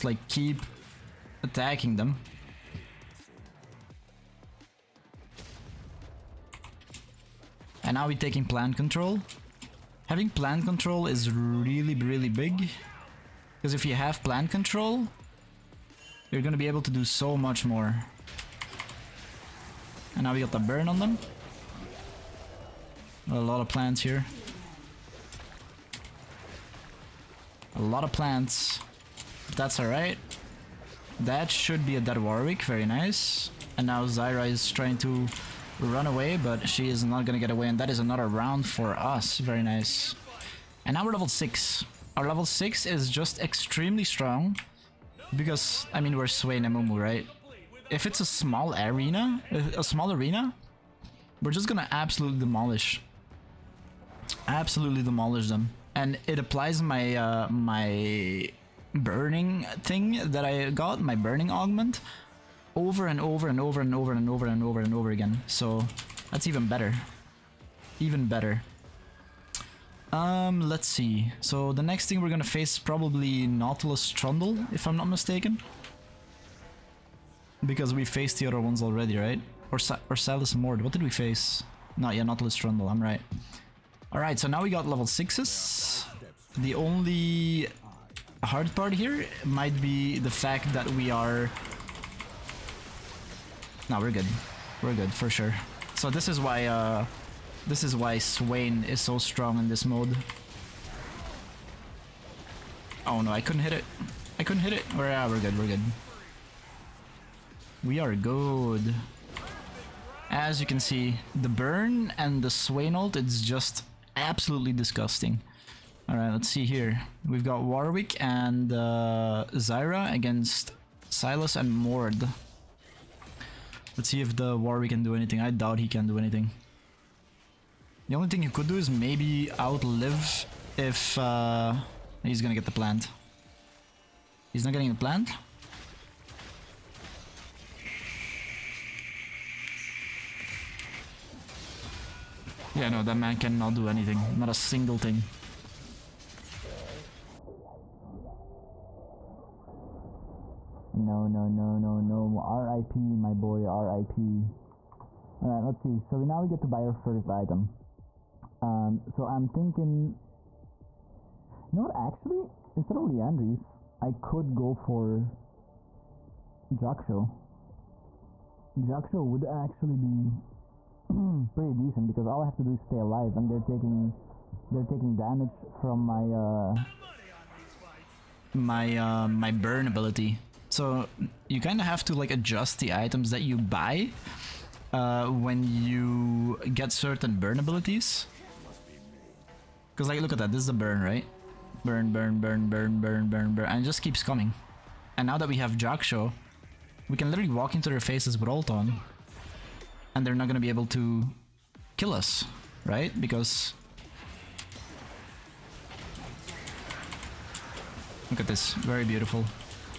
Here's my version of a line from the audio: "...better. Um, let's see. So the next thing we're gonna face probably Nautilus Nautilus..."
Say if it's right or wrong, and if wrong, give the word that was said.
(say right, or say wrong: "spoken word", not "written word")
wrong: "Trundle", not "Nautilus".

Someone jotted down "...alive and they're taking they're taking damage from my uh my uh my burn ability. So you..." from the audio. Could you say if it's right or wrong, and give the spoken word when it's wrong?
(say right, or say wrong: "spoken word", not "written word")
right.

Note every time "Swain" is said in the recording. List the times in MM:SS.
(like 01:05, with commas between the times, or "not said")
00:46, 01:38, 01:52.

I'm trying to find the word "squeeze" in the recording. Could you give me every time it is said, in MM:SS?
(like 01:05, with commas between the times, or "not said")
not said.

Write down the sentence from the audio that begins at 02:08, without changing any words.
The only thing he could do is maybe outlive if uh, he's gonna get the plant.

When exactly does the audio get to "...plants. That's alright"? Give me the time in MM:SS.
00:28.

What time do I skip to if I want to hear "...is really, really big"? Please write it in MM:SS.
00:11.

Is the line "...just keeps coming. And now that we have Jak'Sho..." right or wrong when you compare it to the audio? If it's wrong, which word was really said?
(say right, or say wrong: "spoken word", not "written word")
right.